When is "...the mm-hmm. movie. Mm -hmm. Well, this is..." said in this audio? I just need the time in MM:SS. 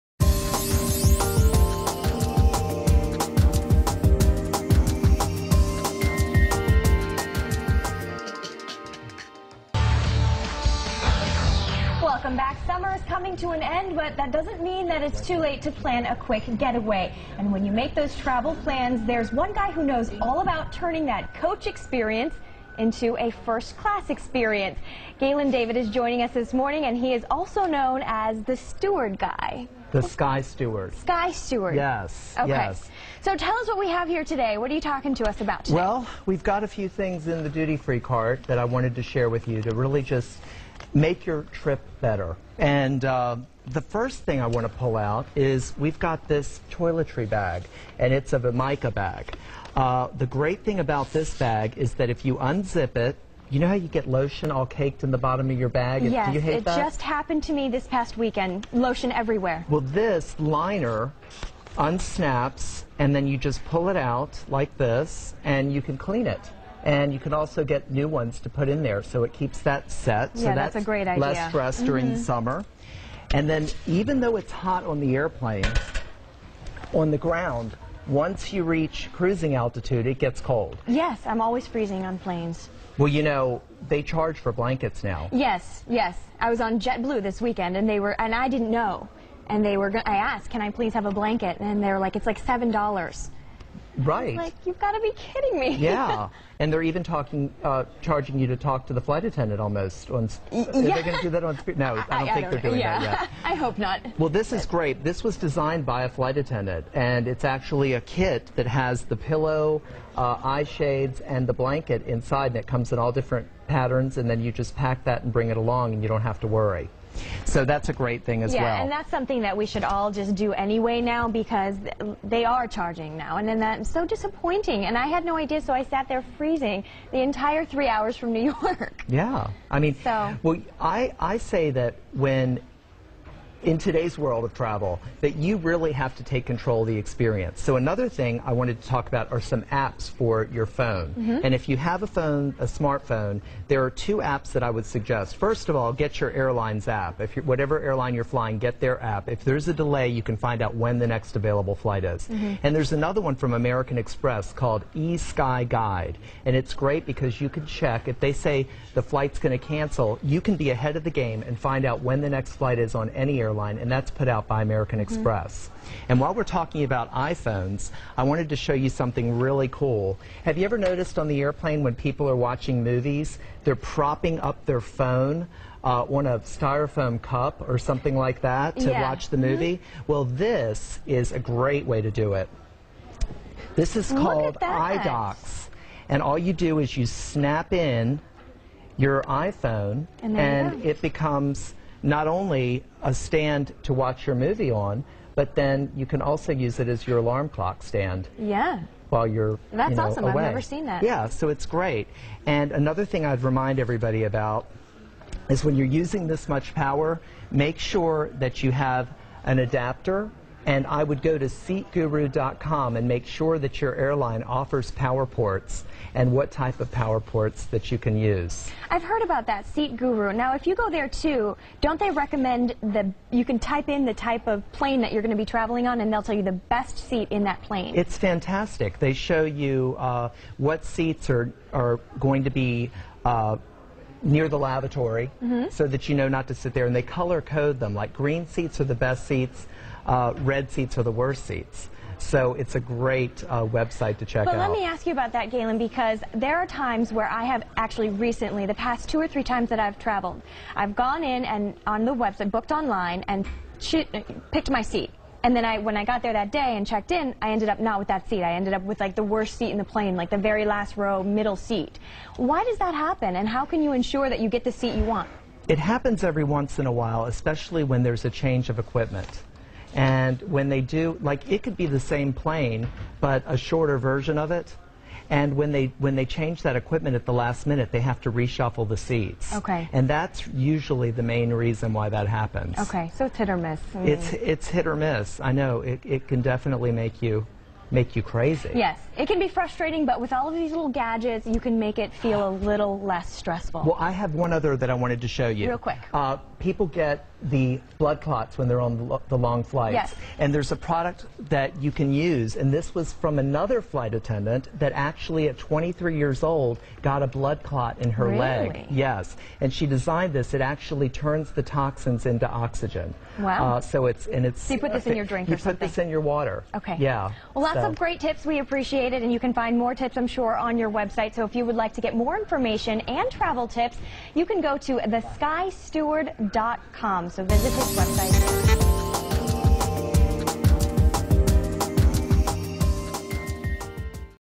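02:59.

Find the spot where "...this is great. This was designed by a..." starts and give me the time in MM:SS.
01:44.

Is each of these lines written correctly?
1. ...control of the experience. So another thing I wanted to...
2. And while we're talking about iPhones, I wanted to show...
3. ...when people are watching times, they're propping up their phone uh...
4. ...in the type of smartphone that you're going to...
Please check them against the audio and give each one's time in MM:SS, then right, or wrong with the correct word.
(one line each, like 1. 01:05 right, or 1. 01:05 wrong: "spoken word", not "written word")
1. 02:16 right
2. 02:46 right
3. 02:51 wrong: "movies", not "times"
4. 03:43 wrong: "plane", not "smartphone".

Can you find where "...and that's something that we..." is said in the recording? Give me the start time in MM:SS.
01:58.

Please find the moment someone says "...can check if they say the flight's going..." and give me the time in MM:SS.
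02:37.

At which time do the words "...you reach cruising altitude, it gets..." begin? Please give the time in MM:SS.
01:18.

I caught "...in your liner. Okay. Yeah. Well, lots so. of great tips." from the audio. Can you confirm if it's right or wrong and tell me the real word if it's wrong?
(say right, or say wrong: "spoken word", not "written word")
wrong: "water", not "liner".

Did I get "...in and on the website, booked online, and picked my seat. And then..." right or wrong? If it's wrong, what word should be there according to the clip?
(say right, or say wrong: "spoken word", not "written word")
right.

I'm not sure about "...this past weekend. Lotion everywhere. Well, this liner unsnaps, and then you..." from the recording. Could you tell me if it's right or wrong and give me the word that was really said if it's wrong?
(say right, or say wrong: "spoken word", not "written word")
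right.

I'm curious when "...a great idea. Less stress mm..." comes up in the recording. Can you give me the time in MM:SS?
01:10.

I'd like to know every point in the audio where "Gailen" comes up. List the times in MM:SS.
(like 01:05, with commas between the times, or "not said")
00:25, 04:05.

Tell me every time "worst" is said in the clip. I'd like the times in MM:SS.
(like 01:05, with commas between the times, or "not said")
04:01, 04:19.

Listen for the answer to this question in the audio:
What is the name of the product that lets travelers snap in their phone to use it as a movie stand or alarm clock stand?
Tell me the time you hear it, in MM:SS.
03:04.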